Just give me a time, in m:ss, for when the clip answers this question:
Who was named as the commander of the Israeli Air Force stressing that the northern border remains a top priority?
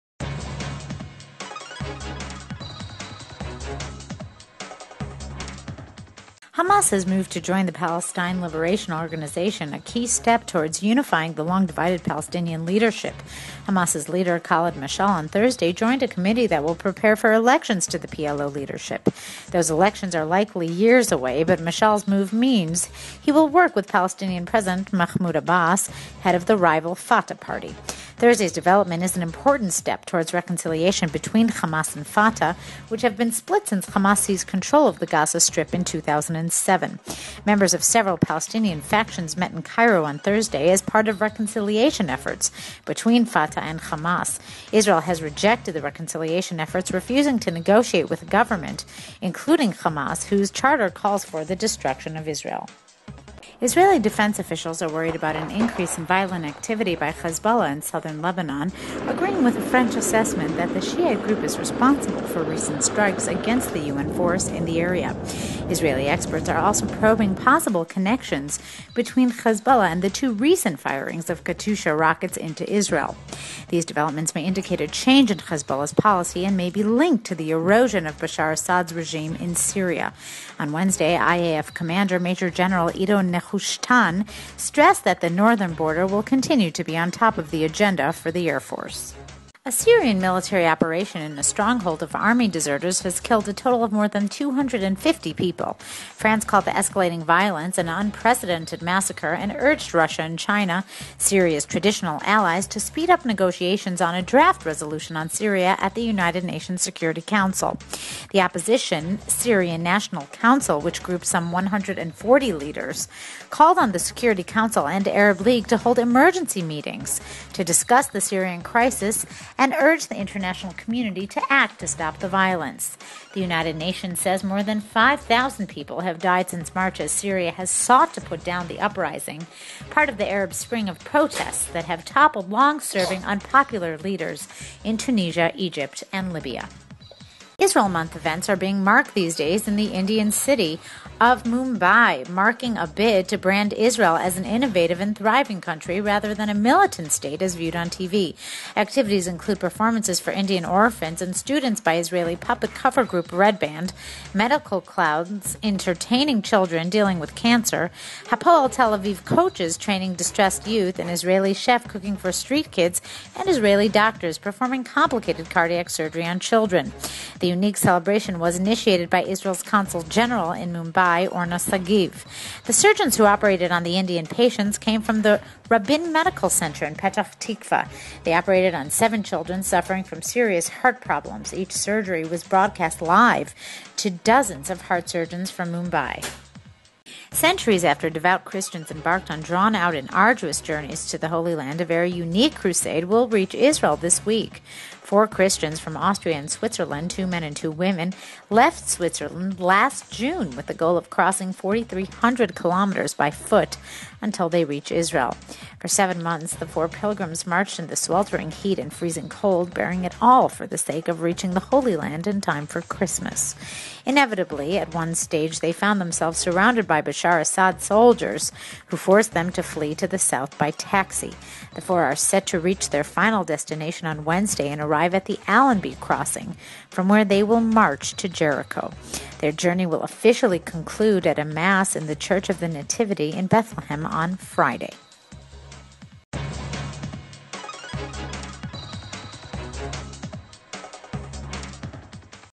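1:22.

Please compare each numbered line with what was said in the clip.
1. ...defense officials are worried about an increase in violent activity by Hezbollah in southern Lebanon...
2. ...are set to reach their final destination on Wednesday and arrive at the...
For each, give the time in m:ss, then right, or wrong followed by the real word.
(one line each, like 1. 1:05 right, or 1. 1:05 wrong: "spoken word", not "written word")
1. 0:53 right
2. 3:42 right.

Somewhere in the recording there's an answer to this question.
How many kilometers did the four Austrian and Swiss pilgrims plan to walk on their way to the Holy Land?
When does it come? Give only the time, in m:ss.
3:21.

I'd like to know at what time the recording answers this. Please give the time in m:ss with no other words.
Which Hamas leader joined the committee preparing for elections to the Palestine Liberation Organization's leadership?
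0:14.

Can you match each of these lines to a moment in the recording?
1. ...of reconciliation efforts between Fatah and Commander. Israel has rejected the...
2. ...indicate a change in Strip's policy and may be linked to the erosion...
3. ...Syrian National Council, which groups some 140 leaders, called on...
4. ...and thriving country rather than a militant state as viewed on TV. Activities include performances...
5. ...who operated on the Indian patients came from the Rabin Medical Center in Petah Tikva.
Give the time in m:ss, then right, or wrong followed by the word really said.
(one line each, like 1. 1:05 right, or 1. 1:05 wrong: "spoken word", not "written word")
1. 0:41 wrong: "Hamas", not "Commander"
2. 1:14 wrong: "Hezbollah", not "Strip"
3. 1:49 right
4. 2:24 right
5. 2:53 right.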